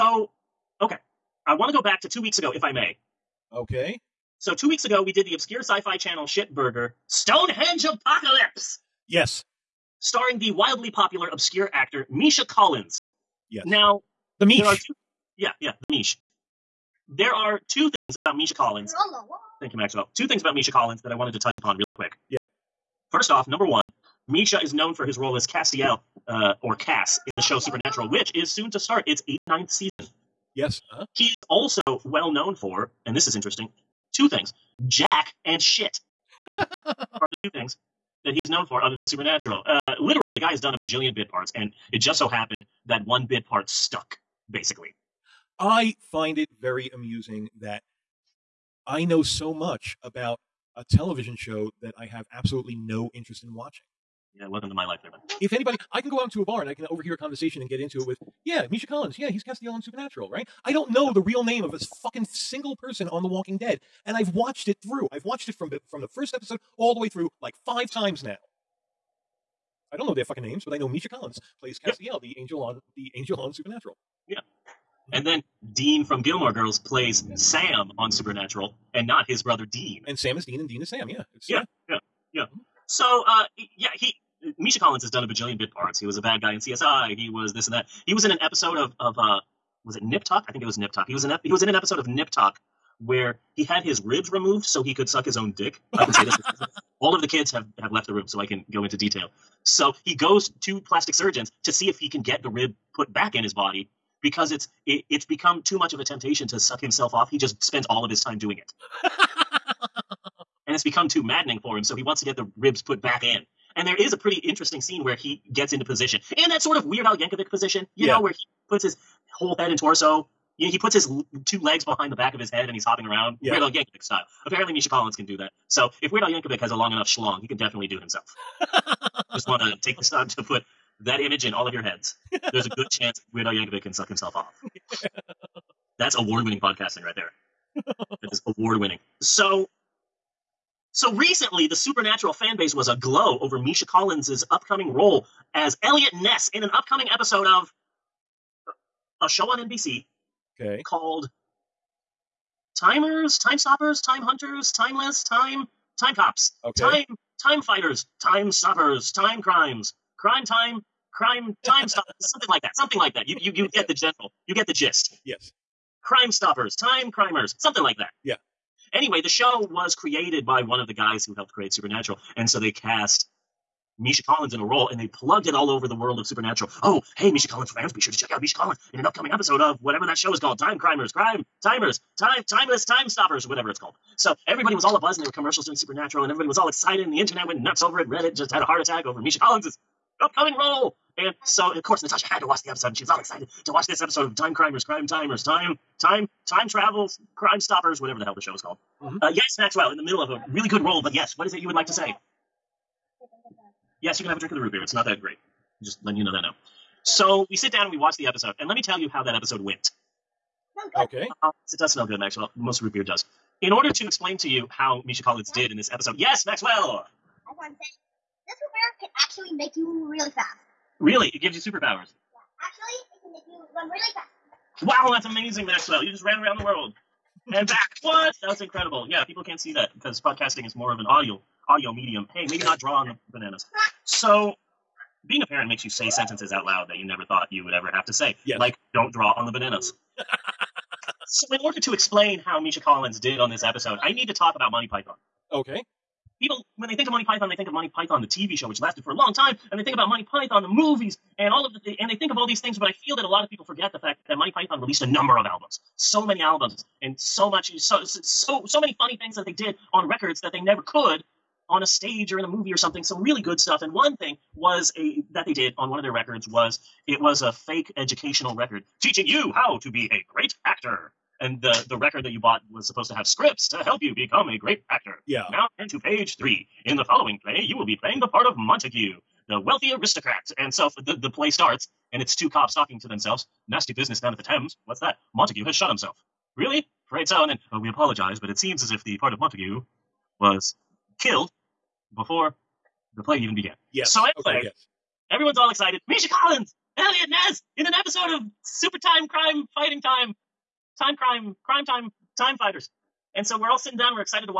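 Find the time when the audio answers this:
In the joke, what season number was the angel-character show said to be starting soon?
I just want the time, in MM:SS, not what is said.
00:29.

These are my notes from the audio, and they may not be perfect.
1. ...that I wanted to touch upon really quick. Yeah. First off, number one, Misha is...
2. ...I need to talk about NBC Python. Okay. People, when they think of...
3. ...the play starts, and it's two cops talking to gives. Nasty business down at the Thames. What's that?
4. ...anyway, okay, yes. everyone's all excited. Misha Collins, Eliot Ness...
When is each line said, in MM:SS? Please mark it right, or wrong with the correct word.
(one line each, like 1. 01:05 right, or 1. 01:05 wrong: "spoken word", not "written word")
1. 00:21 right
2. 04:04 wrong: "Monty", not "NBC"
3. 04:41 wrong: "themselves", not "gives"
4. 04:54 right.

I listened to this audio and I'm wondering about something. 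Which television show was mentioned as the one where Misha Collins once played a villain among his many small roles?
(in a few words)
CSI.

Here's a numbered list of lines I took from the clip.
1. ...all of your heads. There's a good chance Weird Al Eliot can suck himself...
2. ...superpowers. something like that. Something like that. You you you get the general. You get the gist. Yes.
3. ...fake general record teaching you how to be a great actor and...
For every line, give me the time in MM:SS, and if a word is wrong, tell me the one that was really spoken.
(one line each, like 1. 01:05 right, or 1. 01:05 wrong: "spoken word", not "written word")
1. 02:11 wrong: "Yankovic", not "Eliot"
2. 02:41 wrong: "stoppers", not "superpowers"
3. 04:27 wrong: "educational", not "general".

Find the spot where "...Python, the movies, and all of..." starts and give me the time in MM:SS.
04:10.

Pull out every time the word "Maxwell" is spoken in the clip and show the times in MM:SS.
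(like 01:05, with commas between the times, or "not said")
00:19, 03:19, 03:32, 03:36, 03:45.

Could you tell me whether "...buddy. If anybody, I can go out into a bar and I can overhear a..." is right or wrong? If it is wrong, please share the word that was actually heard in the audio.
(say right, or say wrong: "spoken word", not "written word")
right.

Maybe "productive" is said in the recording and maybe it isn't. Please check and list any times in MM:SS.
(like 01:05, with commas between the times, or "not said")
not said.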